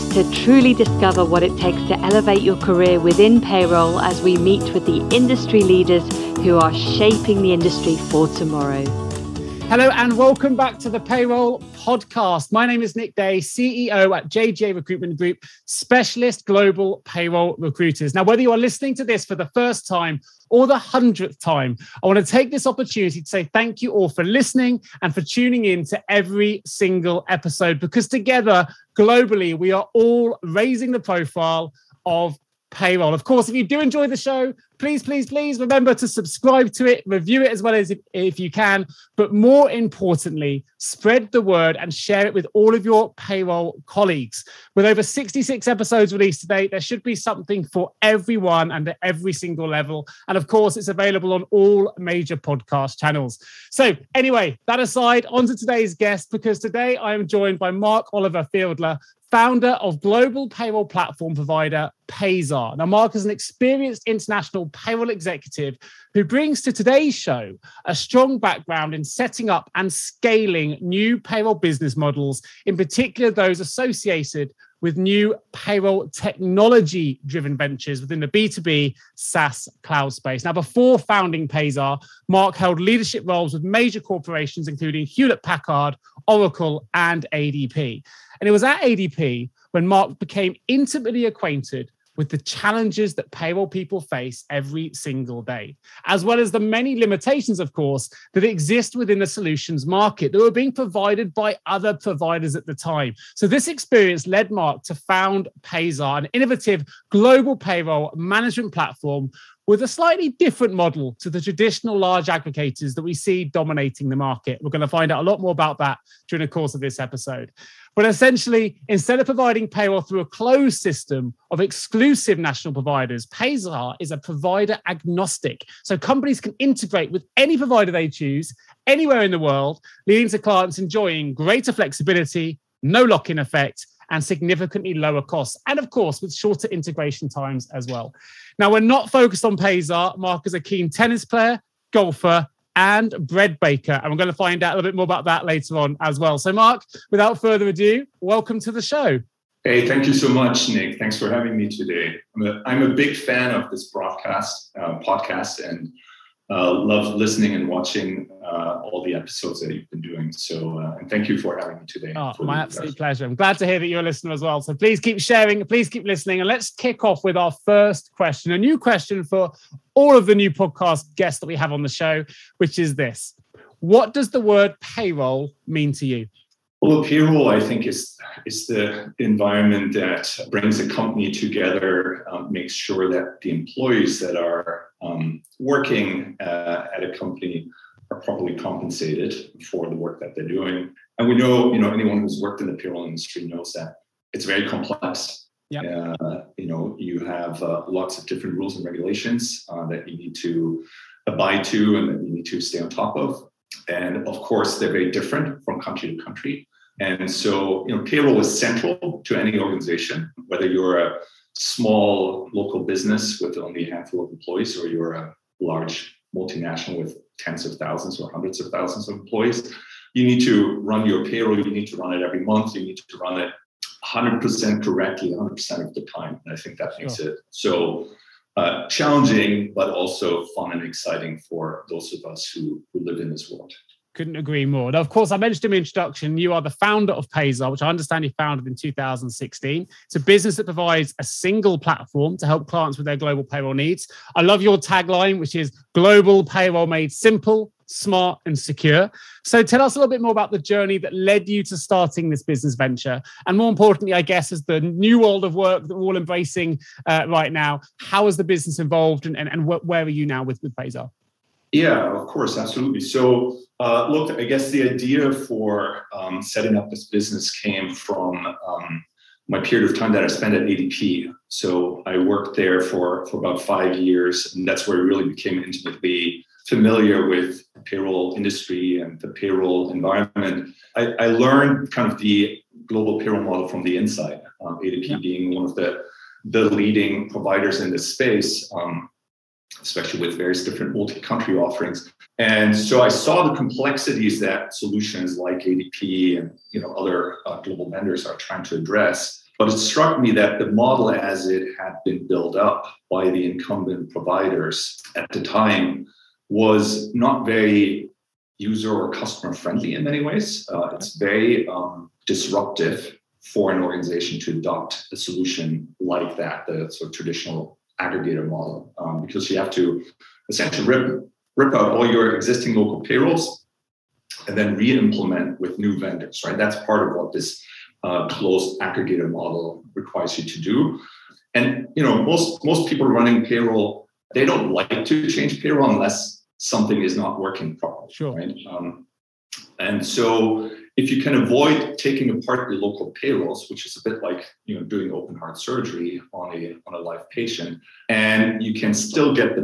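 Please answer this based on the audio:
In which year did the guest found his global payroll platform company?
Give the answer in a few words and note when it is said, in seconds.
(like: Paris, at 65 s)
2016, at 238 s.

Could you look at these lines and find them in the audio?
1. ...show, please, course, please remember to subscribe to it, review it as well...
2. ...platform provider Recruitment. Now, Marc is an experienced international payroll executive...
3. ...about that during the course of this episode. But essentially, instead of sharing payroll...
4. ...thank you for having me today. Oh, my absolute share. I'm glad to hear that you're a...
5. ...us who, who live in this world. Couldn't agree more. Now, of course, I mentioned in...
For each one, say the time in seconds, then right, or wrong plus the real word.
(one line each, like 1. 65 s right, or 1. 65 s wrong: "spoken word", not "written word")
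1. 34 s wrong: "please", not "course"
2. 60 s wrong: "Payzaar", not "Recruitment"
3. 115 s wrong: "providing", not "sharing"
4. 161 s wrong: "pleasure", not "share"
5. 232 s right.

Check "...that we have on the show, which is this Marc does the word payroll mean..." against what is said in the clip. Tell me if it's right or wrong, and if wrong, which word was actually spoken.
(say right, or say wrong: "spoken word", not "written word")
wrong: "What", not "Marc".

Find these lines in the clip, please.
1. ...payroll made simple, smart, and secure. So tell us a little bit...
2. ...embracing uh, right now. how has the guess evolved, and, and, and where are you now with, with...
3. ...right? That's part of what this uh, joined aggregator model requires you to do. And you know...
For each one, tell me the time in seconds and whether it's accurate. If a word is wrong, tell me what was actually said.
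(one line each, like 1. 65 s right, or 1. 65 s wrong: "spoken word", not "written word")
1. 246 s right
2. 256 s wrong: "business", not "guess"
3. 326 s wrong: "closed", not "joined".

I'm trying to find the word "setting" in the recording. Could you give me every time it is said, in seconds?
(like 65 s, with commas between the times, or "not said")
69 s, 266 s.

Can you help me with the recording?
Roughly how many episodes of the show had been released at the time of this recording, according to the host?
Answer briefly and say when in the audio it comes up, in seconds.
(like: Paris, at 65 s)
66, at 45 s.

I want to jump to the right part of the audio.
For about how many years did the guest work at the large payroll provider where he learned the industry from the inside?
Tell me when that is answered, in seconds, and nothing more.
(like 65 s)
273 s.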